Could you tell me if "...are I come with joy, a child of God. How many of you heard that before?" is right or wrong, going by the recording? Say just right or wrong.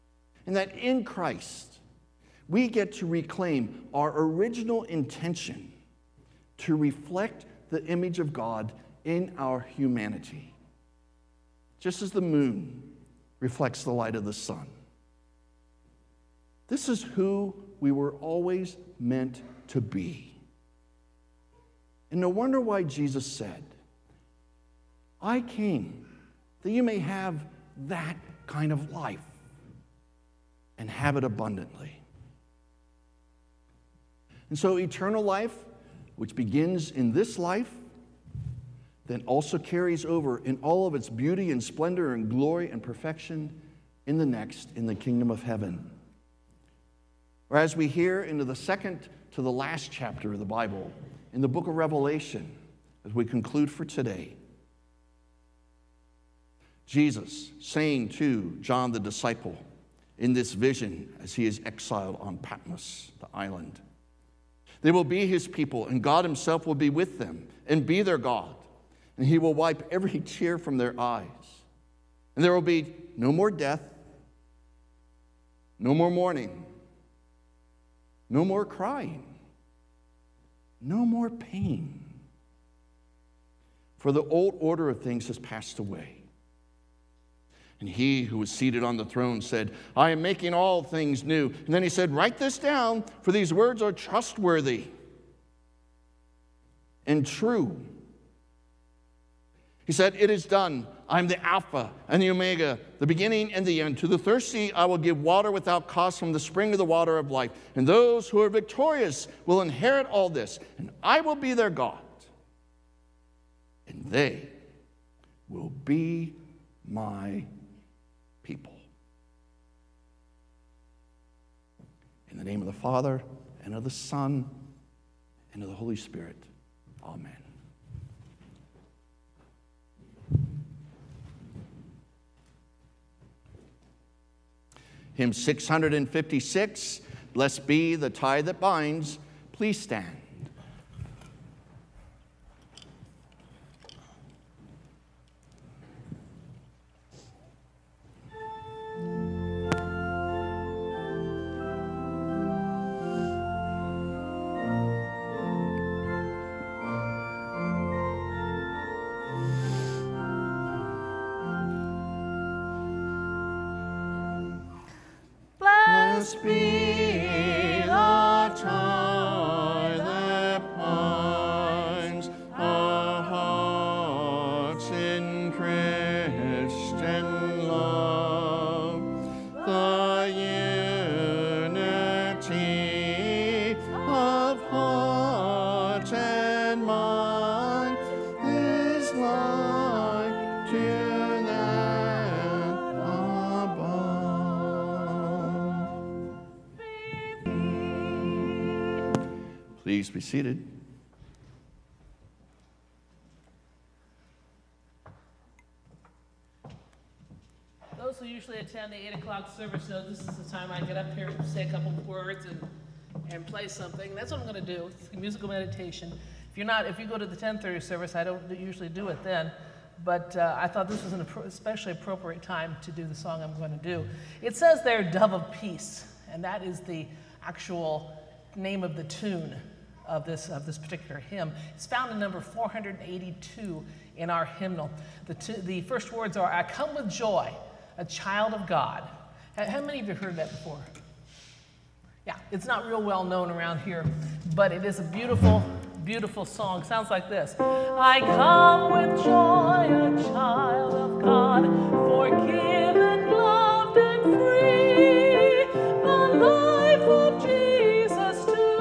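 right.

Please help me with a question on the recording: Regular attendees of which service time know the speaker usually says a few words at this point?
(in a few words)
8 o'clock.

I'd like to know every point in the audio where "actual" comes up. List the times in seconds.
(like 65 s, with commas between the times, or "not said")
227 s.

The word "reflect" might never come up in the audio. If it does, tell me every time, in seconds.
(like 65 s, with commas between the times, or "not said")
6 s, 13 s.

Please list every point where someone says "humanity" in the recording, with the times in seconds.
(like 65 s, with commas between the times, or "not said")
9 s.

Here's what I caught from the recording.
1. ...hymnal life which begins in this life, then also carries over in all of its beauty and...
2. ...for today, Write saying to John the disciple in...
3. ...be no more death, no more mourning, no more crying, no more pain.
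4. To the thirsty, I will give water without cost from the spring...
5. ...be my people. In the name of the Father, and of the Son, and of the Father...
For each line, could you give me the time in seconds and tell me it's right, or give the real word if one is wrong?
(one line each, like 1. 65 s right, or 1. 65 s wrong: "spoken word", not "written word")
1. 34 s wrong: "eternal", not "hymnal"
2. 53 s wrong: "Jesus", not "Write"
3. 72 s right
4. 103 s right
5. 115 s wrong: "Holy", not "Father".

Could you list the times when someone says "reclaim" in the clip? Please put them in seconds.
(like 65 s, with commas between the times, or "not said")
3 s.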